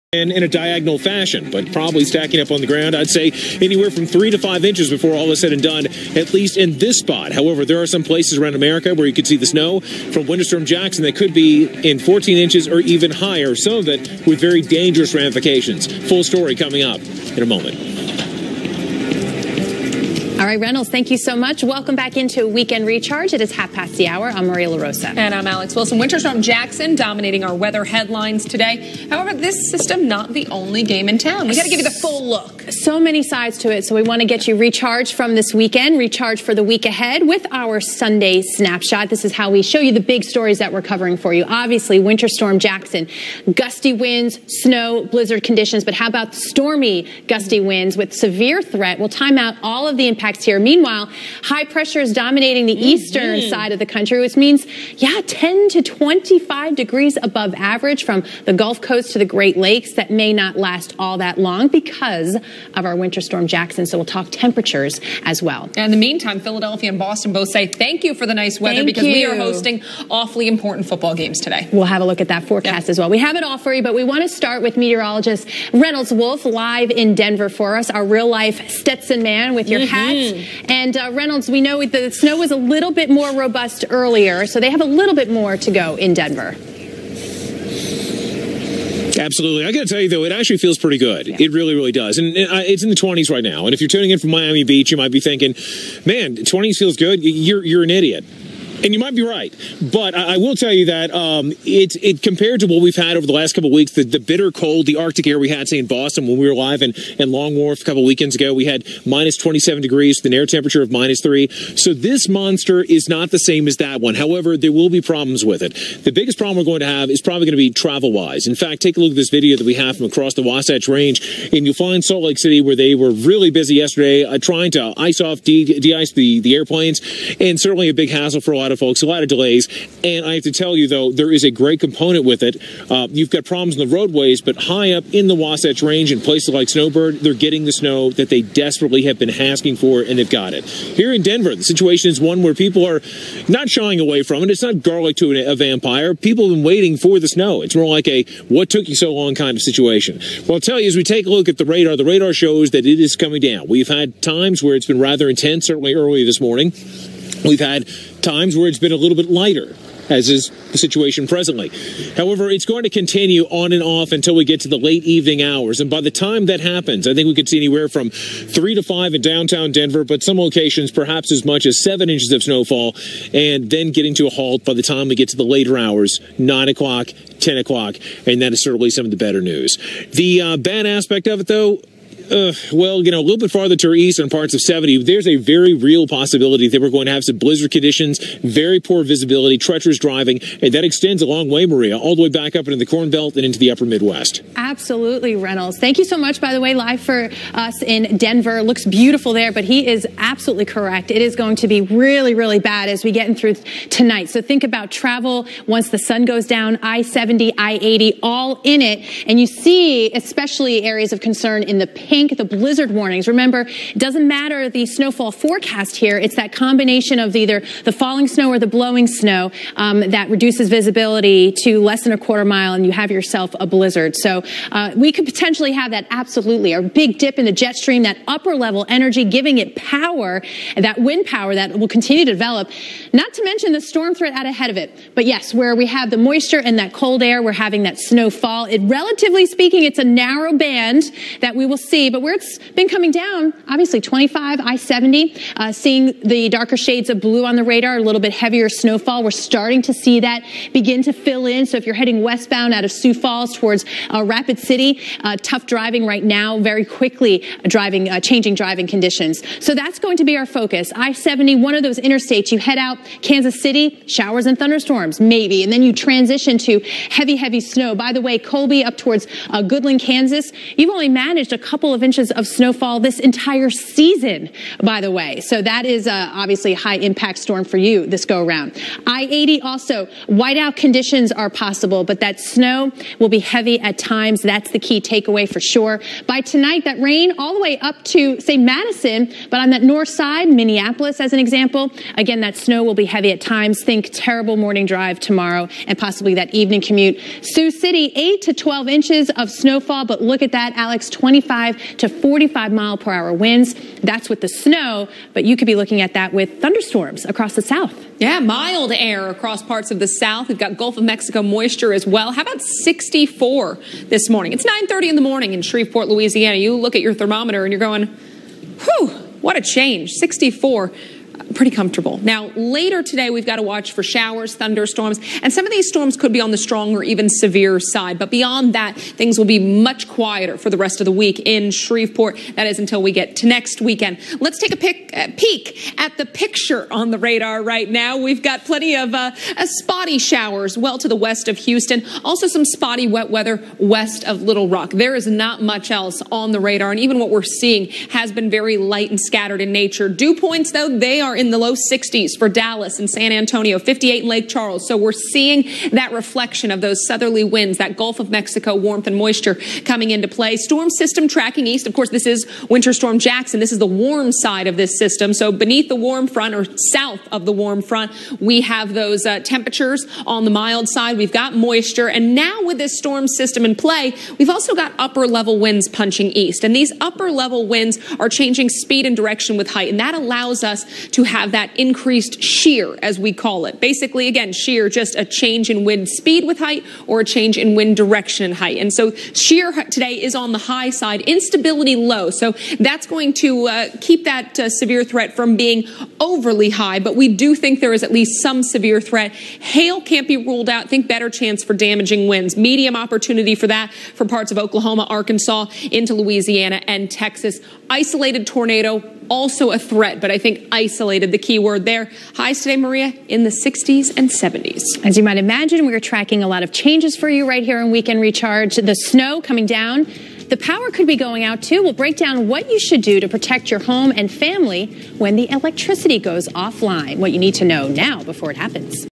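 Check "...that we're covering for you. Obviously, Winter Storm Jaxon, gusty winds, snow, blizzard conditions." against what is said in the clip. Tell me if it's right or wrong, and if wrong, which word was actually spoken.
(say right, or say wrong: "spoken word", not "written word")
right.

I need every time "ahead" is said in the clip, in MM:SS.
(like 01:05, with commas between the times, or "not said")
00:36, 03:54.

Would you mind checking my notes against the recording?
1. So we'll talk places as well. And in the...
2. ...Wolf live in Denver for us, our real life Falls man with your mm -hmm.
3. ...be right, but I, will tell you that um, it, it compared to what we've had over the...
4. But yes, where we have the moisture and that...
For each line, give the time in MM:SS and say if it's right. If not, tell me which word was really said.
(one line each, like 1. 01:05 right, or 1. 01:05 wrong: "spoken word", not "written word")
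1. 01:03 wrong: "temperatures", not "places"
2. 01:16 wrong: "Stetson", not "Falls"
3. 01:39 right
4. 03:55 right.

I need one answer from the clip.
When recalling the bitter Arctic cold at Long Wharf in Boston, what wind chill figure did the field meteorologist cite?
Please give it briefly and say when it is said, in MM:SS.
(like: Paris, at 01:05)
-27, at 01:49.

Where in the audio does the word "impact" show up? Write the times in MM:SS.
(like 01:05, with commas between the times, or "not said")
00:50, 04:36.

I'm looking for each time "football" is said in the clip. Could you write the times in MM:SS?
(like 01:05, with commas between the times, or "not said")
01:10.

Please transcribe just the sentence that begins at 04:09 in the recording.
We're starting to see that begin to fill in.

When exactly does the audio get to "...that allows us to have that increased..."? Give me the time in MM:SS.
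06:19.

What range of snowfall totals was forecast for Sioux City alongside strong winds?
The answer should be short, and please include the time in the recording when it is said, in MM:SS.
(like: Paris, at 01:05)
8 to 12 inches, at 04:58.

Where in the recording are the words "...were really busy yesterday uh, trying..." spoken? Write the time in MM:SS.
02:02.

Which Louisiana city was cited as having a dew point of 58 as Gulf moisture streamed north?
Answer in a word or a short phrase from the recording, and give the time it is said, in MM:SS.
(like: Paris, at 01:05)
Lake Charles, at 05:54.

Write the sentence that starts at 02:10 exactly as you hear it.
And I have to tell you, though, there is a great component with it.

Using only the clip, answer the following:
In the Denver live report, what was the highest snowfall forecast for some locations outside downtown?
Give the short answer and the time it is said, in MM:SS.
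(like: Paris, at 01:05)
7 inches, at 02:51.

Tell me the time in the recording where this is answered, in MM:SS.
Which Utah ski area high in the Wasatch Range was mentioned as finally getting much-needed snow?
02:16.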